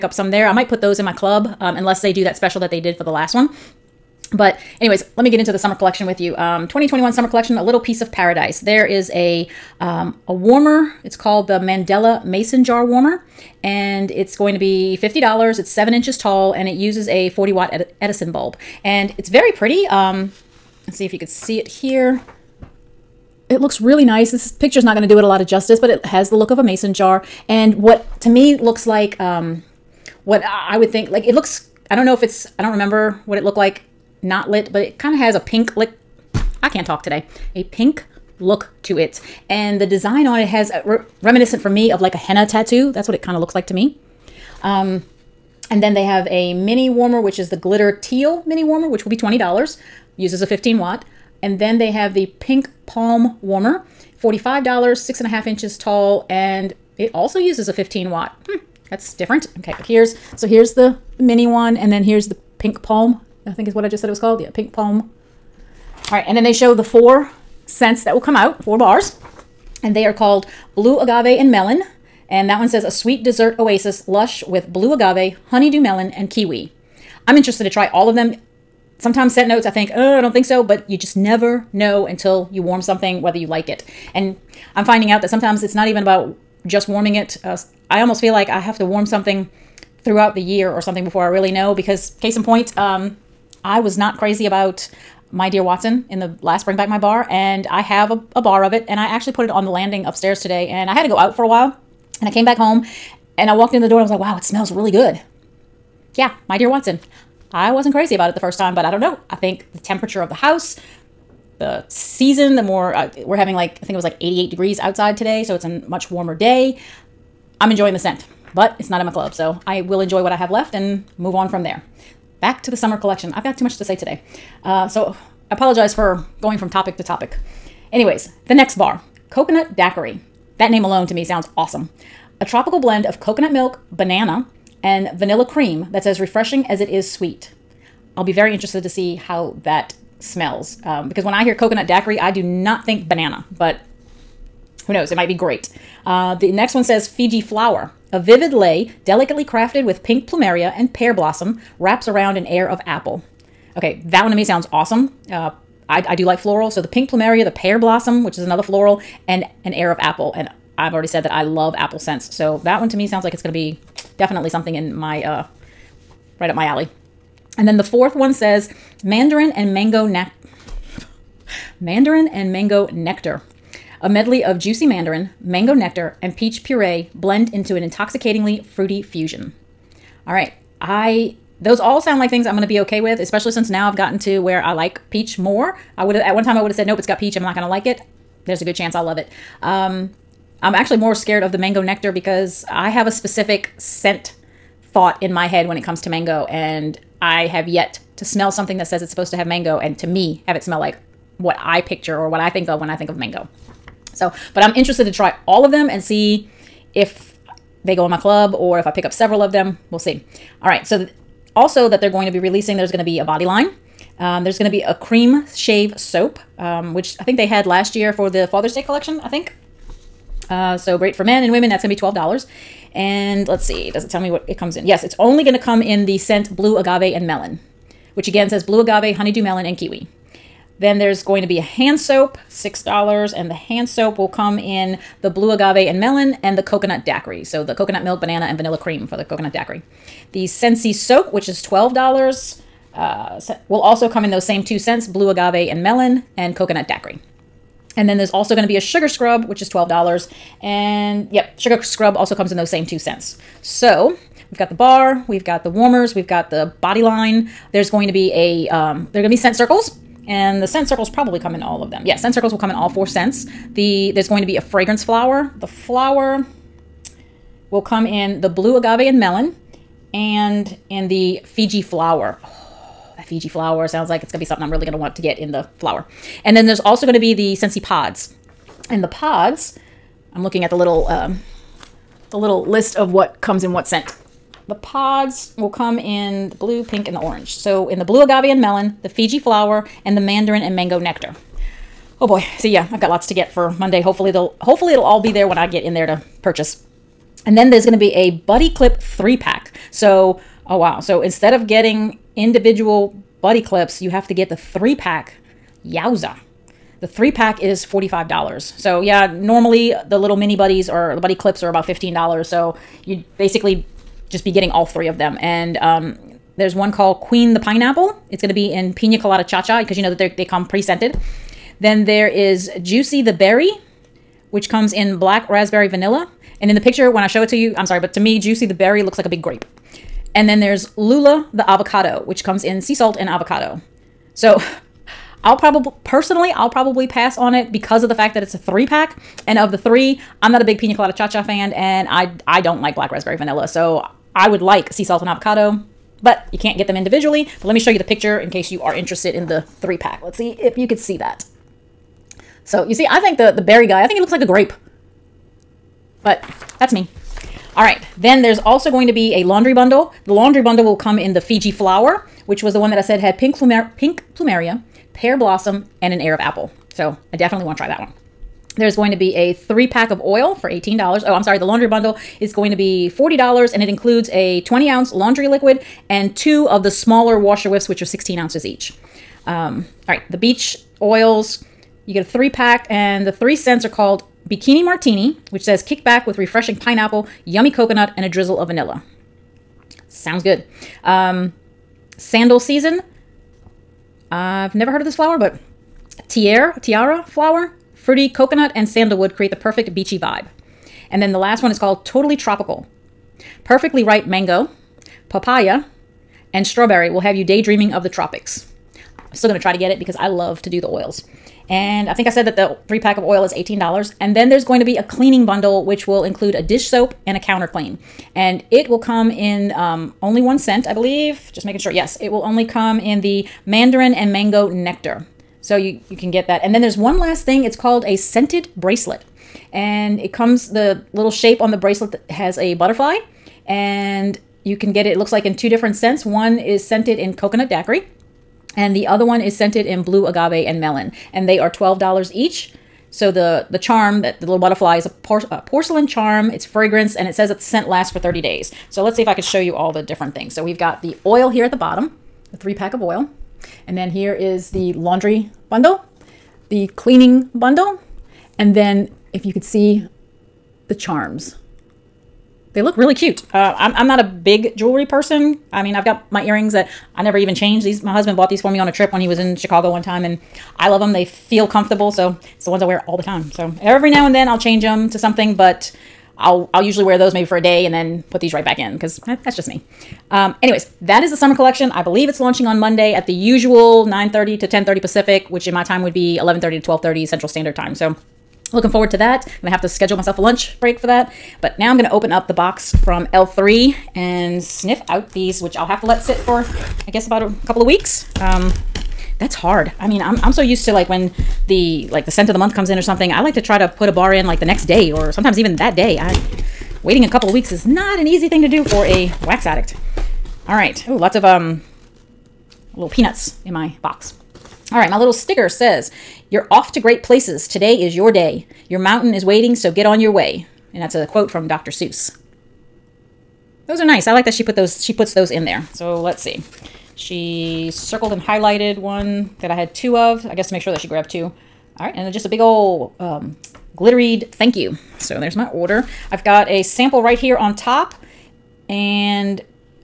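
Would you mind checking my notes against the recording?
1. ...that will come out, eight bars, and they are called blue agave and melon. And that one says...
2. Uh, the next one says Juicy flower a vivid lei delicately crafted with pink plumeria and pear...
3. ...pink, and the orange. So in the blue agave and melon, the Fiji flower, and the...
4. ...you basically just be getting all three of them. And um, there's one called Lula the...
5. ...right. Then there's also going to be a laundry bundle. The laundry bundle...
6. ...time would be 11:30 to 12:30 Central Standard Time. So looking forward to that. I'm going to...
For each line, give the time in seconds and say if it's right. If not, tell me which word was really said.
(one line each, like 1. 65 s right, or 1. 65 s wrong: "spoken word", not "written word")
1. 68 s wrong: "four", not "eight"
2. 146 s wrong: "Fiji", not "Juicy"
3. 286 s right
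4. 313 s wrong: "Queen", not "Lula"
5. 357 s right
6. 485 s right.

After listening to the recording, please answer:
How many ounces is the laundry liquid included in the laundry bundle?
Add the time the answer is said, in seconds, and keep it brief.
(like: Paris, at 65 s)
20 ounces, at 374 s.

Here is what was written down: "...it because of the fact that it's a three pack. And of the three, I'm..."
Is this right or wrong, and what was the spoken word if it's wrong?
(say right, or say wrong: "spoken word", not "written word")
right.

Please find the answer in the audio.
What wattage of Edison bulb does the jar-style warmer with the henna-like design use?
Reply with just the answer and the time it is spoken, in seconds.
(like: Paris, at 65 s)
40 watt, at 17 s.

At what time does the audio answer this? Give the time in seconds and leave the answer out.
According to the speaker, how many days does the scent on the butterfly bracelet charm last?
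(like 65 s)
448 s.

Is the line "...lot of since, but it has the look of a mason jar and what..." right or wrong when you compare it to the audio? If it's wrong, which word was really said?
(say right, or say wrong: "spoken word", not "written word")
wrong: "justice", not "since".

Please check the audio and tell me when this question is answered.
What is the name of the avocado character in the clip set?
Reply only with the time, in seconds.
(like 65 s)
330 s.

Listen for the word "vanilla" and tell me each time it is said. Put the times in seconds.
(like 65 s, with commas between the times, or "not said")
135 s, 238 s, 325 s, 343 s, 388 s.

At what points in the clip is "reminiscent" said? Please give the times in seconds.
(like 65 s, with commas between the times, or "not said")
41 s.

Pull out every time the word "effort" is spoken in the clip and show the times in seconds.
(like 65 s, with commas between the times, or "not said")
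not said.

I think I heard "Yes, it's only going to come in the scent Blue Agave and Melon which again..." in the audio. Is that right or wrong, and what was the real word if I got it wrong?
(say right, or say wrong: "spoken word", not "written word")
right.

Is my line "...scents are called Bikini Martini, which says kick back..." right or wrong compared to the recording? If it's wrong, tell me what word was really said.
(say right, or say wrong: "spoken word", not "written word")
right.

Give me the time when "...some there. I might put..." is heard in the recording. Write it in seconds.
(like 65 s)
0 s.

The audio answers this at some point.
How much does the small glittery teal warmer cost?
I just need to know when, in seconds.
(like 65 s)
49 s.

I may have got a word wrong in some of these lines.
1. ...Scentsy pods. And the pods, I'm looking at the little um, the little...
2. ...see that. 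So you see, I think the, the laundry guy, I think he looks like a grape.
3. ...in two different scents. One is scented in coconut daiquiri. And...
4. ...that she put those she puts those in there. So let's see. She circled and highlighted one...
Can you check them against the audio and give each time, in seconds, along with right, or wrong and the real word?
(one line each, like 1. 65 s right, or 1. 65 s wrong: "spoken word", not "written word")
1. 277 s right
2. 350 s wrong: "berry", not "laundry"
3. 435 s right
4. 524 s right.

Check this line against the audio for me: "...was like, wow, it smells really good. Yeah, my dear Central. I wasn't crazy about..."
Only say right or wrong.
wrong.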